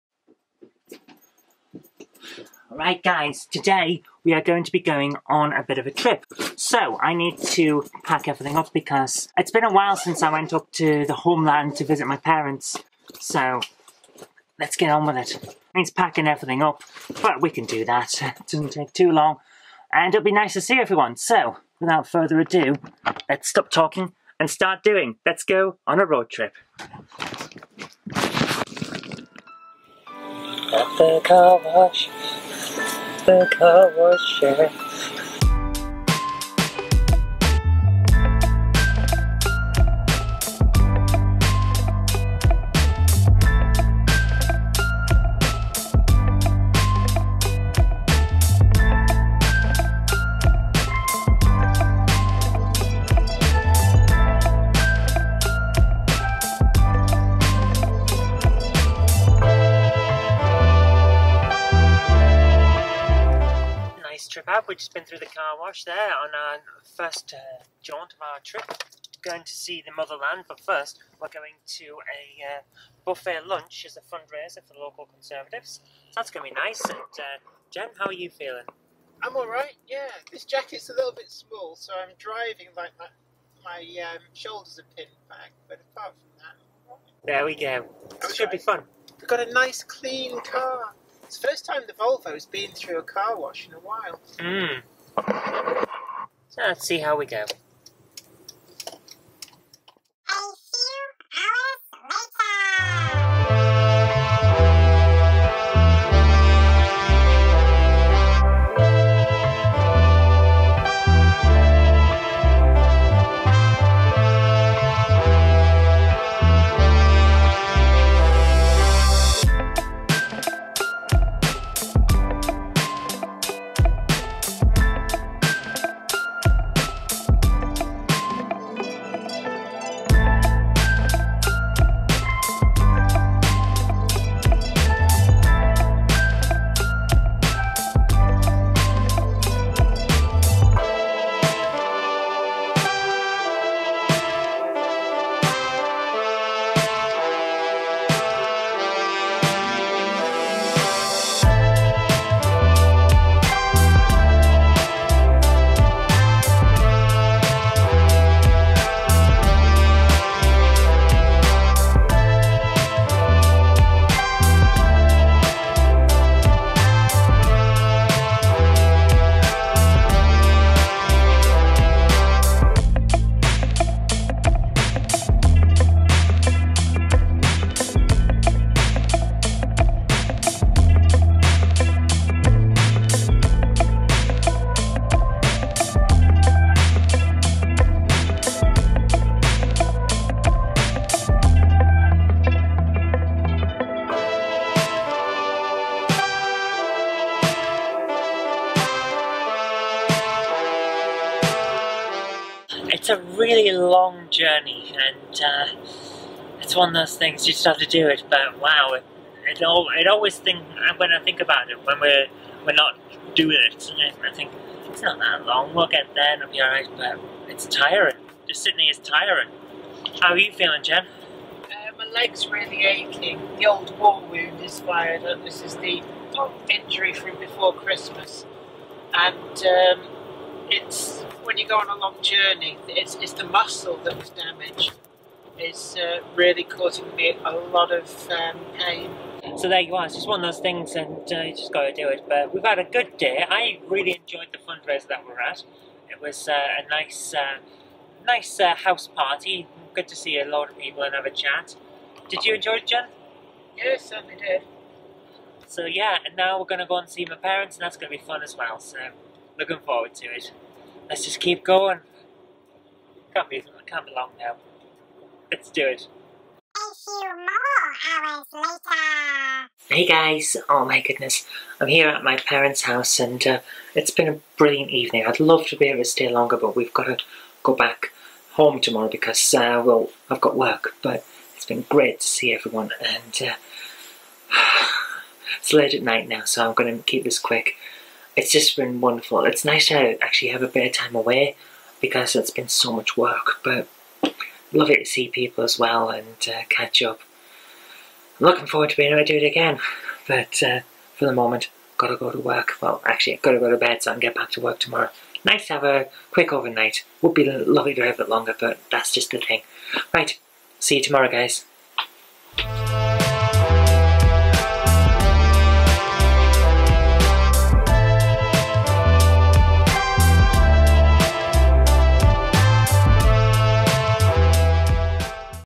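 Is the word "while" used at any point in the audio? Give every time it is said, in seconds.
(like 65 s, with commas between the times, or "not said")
9 s, 93 s.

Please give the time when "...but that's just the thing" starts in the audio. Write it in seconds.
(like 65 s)
308 s.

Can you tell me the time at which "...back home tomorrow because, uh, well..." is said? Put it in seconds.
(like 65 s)
277 s.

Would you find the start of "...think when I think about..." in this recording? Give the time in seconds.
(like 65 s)
210 s.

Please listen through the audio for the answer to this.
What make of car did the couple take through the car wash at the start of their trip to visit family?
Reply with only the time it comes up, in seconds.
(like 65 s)
91 s.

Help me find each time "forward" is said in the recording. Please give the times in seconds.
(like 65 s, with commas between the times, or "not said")
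259 s, 298 s.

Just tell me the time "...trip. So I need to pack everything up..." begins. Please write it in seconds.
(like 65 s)
5 s.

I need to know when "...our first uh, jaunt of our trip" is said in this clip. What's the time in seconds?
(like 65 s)
66 s.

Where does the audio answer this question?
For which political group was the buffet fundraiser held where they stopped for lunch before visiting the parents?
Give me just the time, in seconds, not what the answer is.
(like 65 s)
74 s.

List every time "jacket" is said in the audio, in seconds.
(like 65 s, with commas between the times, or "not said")
80 s.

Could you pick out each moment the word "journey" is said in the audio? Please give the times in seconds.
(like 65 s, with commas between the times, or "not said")
204 s, 232 s.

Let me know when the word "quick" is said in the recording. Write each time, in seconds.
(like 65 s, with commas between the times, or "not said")
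287 s, 306 s.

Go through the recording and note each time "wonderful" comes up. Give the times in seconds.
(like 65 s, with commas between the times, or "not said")
289 s.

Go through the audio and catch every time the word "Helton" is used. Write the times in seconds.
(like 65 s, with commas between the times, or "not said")
not said.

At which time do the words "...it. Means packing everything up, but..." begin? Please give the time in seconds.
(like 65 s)
15 s.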